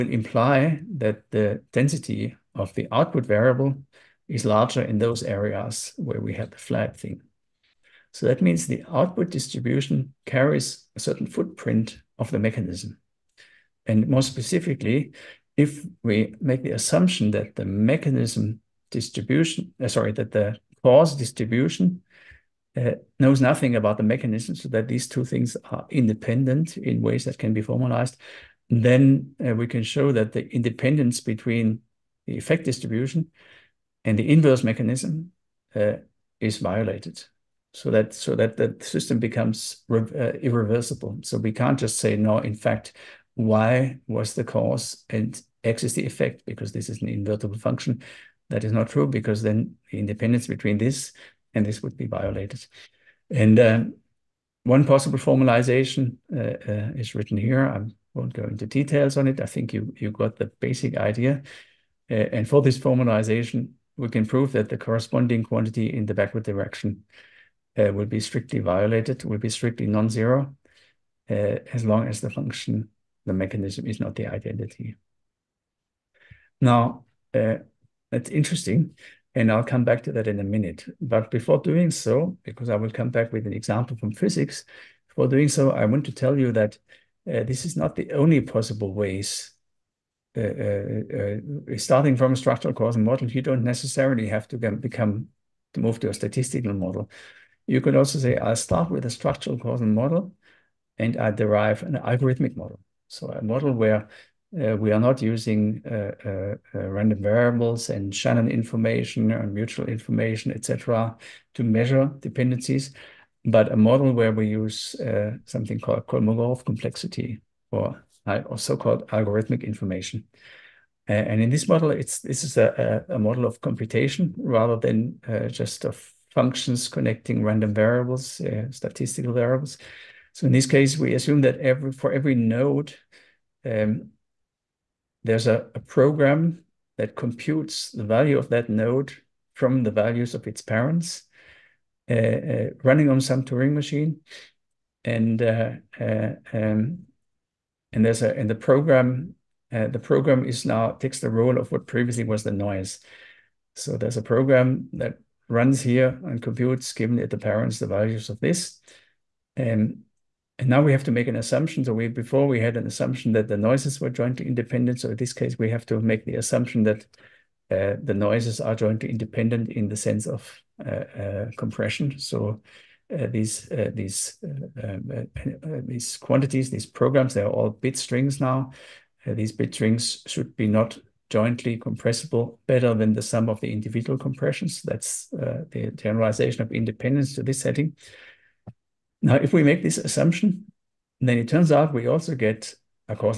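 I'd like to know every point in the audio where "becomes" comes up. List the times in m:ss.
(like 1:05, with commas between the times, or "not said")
0:39, 1:34.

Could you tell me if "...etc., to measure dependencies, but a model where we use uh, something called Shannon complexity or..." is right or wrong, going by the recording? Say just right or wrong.
wrong.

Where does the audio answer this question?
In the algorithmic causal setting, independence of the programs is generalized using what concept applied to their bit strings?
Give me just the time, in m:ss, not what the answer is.
2:51.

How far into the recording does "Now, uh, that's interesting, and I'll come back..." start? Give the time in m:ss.
1:16.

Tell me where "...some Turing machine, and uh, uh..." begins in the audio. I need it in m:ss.
2:23.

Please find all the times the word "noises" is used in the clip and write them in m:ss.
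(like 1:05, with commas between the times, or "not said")
2:32, 2:43, 2:48.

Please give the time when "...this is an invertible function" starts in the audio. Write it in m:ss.
0:46.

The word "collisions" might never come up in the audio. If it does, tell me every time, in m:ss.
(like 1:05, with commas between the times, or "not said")
not said.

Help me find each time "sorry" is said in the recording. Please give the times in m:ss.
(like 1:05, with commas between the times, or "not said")
0:19.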